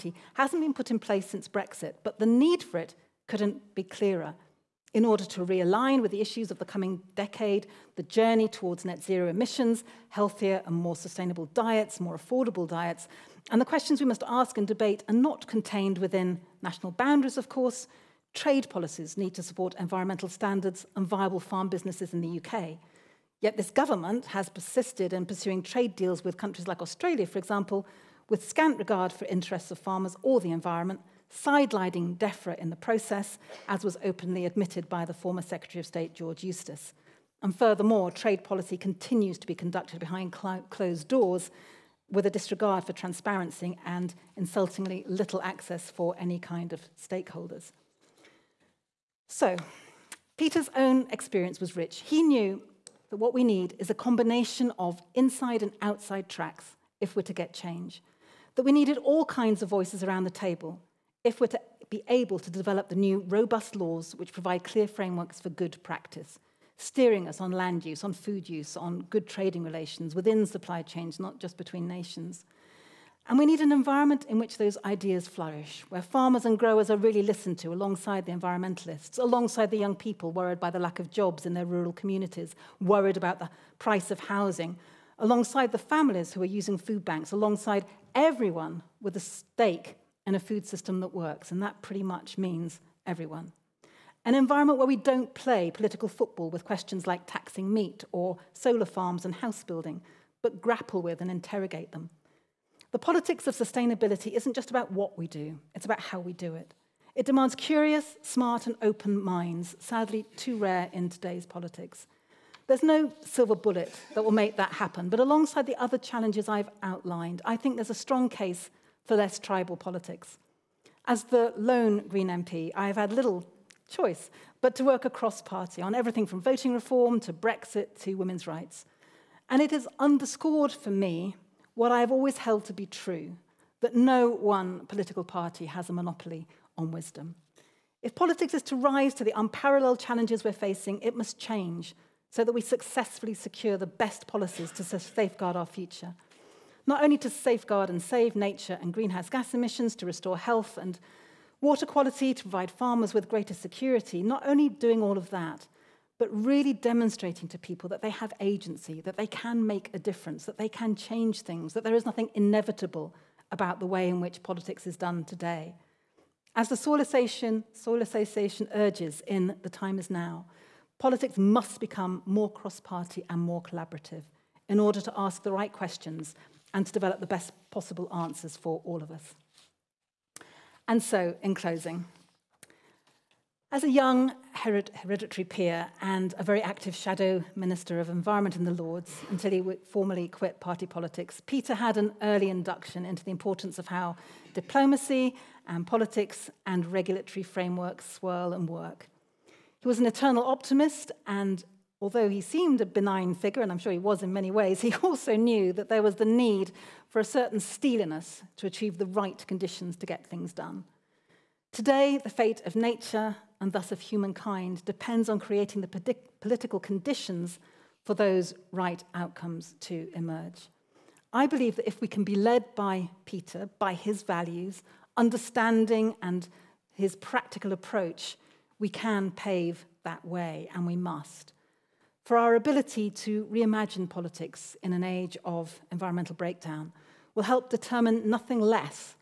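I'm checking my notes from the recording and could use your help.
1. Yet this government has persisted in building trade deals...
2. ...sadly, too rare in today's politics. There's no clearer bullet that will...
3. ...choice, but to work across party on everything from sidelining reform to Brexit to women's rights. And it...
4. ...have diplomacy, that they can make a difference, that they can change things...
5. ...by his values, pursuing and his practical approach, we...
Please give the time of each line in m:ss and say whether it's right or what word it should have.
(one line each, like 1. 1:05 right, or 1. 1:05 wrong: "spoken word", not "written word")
1. 0:23 wrong: "pursuing", not "building"
2. 1:49 wrong: "silver", not "clearer"
3. 2:03 wrong: "voting", not "sidelining"
4. 2:38 wrong: "agency", not "diplomacy"
5. 3:43 wrong: "understanding", not "pursuing".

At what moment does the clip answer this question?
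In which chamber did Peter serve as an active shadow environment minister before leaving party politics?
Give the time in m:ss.
3:08.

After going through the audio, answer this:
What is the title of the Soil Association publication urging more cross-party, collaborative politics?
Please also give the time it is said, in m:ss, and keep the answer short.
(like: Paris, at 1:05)
The Time Is Now, at 2:49.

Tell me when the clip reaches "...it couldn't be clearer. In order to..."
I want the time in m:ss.
0:02.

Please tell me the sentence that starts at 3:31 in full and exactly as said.
Today, the fate of nature and thus of humankind depends on creating the political conditions for those right outcomes to emerge.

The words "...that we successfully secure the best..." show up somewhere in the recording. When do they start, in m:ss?
2:22.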